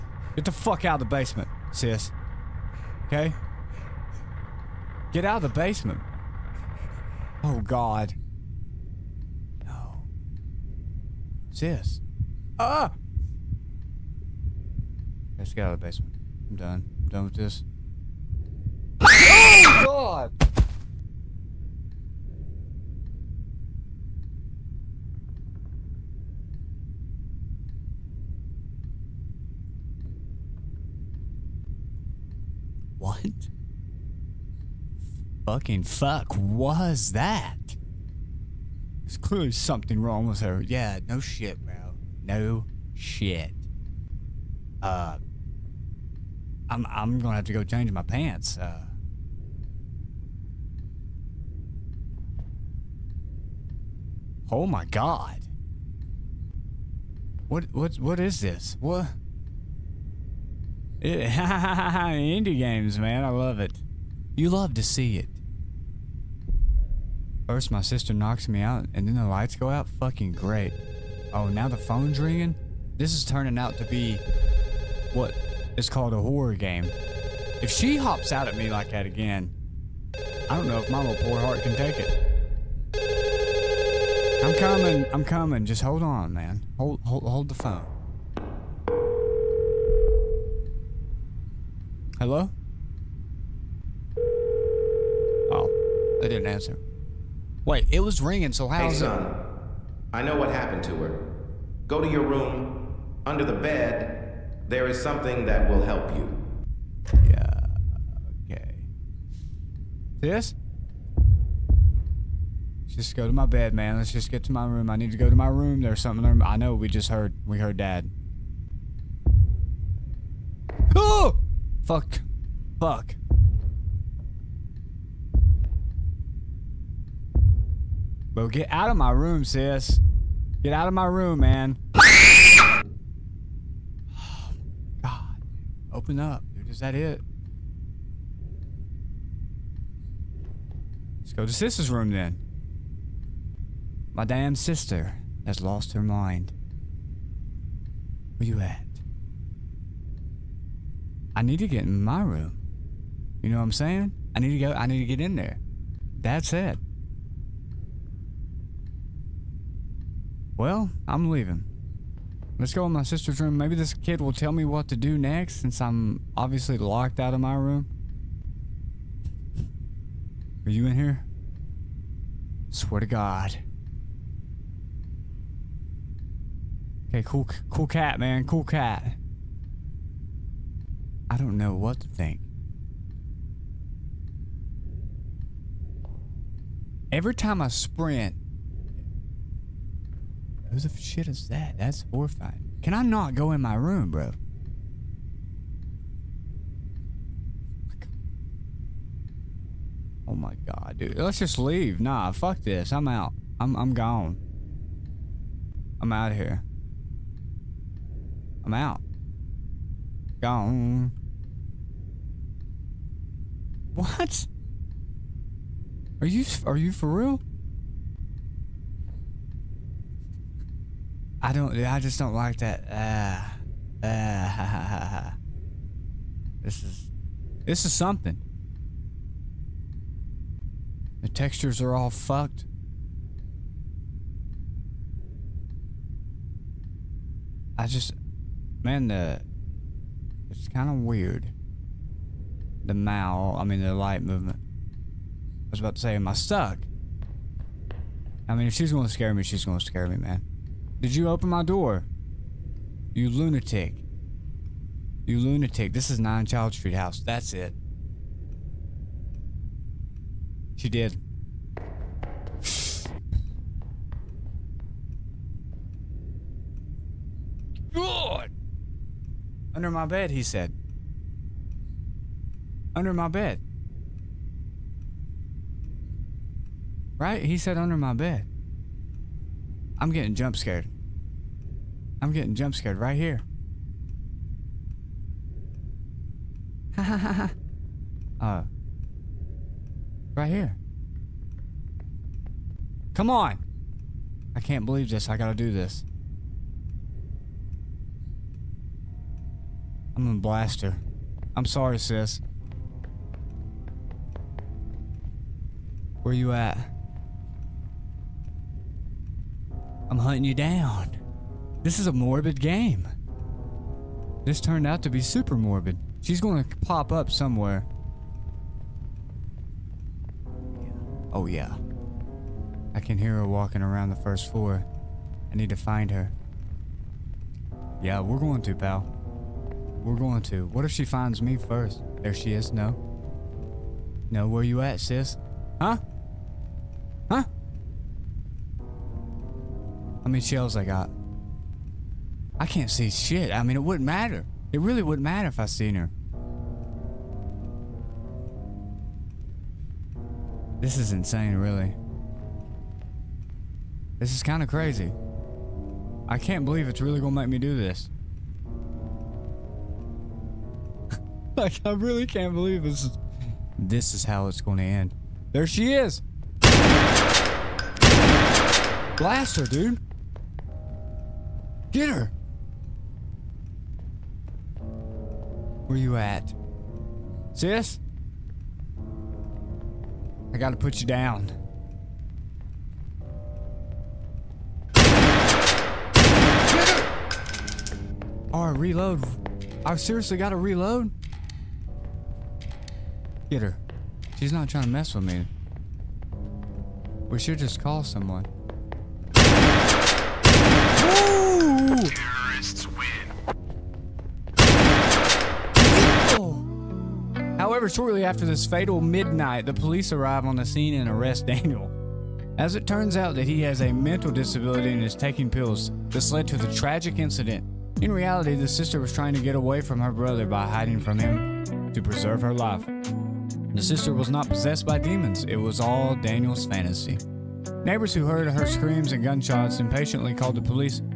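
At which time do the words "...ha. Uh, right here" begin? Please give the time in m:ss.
4:47.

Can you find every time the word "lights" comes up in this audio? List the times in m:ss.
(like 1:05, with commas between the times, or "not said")
1:09, 4:03.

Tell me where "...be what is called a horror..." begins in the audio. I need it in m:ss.
1:13.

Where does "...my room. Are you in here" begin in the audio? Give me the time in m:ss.
2:47.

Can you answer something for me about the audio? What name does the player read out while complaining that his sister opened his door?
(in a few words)
9 Child Street House.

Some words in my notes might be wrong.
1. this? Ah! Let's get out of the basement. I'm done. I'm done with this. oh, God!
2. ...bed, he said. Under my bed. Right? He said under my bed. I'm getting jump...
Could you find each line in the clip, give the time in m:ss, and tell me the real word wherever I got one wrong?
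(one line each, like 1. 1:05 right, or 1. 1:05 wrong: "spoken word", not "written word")
1. 0:11 right
2. 4:30 right.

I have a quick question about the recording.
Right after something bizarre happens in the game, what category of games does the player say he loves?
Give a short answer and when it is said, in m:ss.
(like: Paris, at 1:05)
Indie games, at 1:00.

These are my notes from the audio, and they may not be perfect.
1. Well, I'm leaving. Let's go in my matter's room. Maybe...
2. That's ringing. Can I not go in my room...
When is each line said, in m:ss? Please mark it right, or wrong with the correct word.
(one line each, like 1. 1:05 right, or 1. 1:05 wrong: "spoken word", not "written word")
1. 2:40 wrong: "sister", not "matter"
2. 3:11 wrong: "horrifying", not "ringing".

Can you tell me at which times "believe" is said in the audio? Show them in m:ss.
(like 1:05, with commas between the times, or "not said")
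4:54, 5:56, 6:02.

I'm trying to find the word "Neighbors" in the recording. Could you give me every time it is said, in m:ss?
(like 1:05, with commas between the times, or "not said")
7:07.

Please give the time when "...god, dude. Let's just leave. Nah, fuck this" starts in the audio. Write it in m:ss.
3:20.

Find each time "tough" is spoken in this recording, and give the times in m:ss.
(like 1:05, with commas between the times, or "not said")
not said.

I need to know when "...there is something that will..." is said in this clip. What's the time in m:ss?
1:44.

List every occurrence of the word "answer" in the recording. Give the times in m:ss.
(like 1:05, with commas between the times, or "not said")
1:36.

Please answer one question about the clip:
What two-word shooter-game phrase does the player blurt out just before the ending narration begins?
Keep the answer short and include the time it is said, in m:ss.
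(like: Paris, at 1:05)
Terrorists win, at 6:42.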